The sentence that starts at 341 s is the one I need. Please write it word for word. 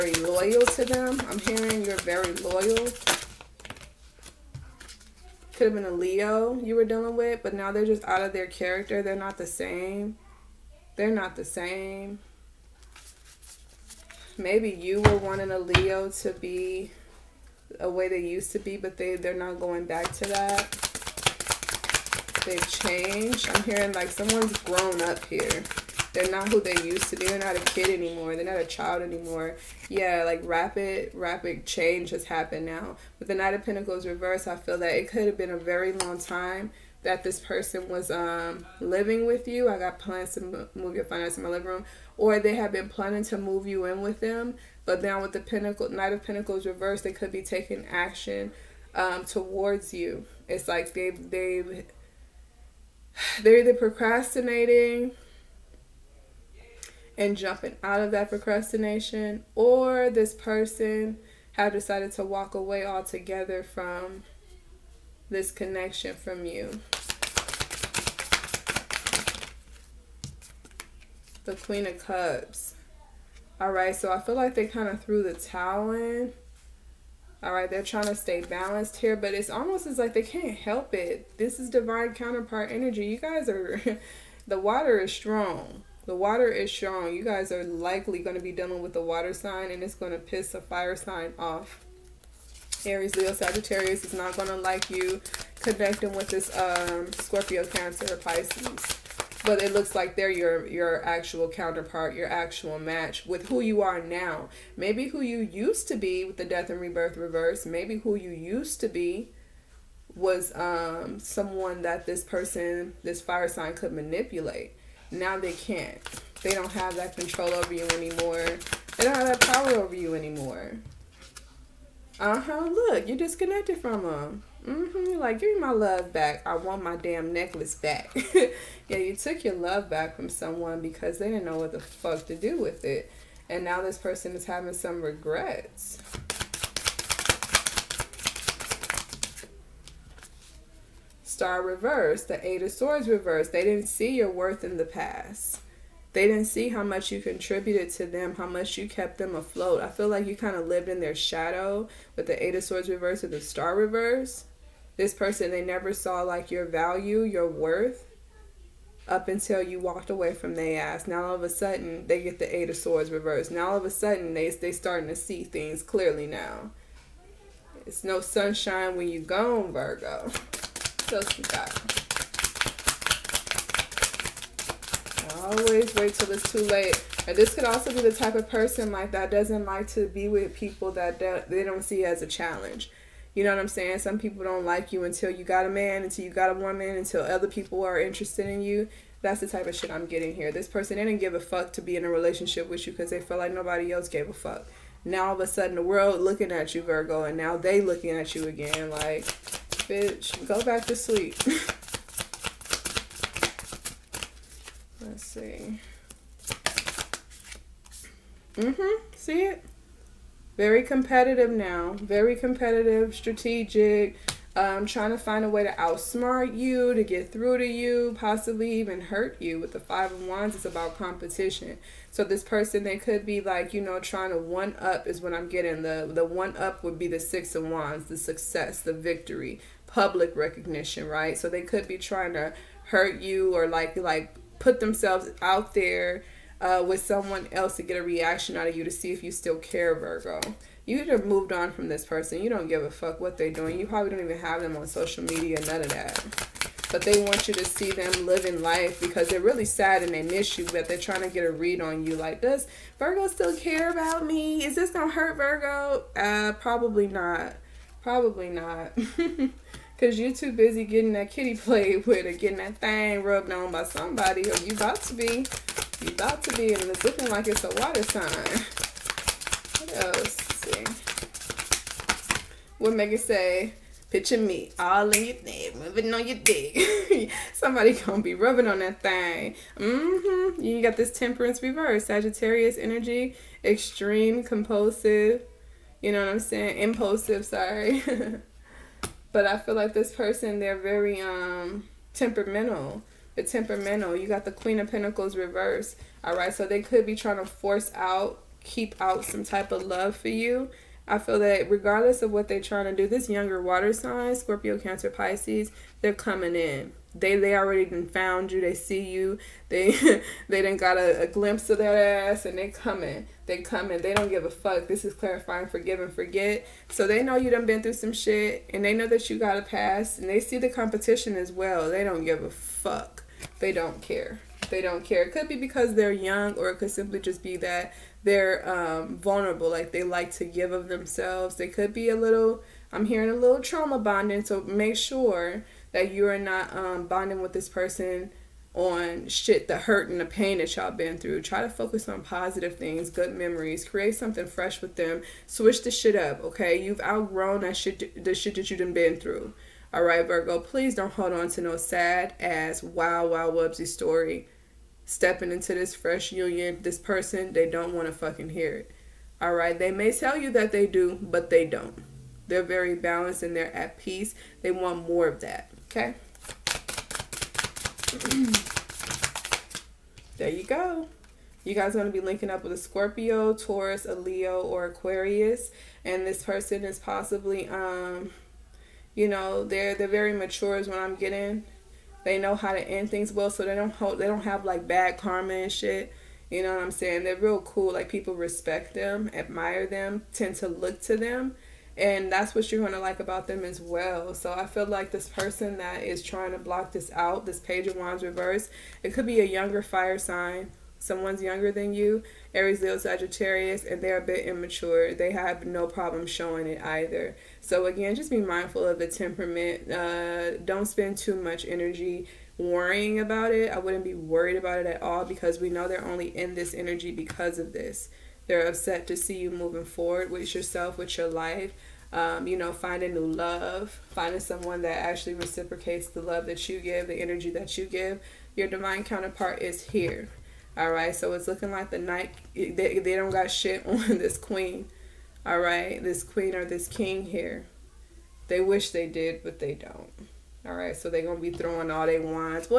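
Try to focus on positive things, good memories.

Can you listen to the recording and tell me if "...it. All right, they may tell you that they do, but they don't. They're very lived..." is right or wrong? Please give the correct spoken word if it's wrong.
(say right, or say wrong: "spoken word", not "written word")
wrong: "balanced", not "lived".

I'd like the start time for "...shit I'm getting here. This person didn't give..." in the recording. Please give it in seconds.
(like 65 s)
189 s.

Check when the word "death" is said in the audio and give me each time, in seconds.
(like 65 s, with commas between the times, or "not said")
106 s.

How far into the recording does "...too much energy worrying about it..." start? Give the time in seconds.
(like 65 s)
411 s.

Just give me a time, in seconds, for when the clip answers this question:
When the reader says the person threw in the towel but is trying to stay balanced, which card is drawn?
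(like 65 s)
71 s.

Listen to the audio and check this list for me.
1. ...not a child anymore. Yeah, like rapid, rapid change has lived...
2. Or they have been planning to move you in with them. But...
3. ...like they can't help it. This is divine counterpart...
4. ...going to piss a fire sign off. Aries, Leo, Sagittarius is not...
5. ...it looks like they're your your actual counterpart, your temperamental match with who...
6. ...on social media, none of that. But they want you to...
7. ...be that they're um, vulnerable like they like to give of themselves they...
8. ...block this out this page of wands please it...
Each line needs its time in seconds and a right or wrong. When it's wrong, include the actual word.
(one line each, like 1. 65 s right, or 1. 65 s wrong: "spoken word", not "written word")
1. 28 s wrong: "happened", not "lived"
2. 42 s right
3. 79 s right
4. 89 s right
5. 99 s wrong: "actual", not "temperamental"
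6. 244 s right
7. 327 s right
8. 396 s wrong: "reverse", not "please".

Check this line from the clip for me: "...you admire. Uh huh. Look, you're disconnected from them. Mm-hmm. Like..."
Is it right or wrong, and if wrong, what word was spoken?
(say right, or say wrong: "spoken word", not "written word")
wrong: "anymore", not "admire".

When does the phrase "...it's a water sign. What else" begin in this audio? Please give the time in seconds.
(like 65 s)
267 s.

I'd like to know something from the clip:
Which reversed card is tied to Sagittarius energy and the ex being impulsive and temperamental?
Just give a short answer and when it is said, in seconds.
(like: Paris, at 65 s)
Temperance, at 281 s.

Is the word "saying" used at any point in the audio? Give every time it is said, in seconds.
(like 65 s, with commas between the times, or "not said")
183 s, 286 s, 386 s.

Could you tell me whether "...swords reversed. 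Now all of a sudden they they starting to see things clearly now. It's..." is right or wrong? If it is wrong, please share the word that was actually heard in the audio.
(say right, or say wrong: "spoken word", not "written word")
right.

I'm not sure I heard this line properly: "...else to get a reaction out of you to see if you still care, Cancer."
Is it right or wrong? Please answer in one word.
wrong.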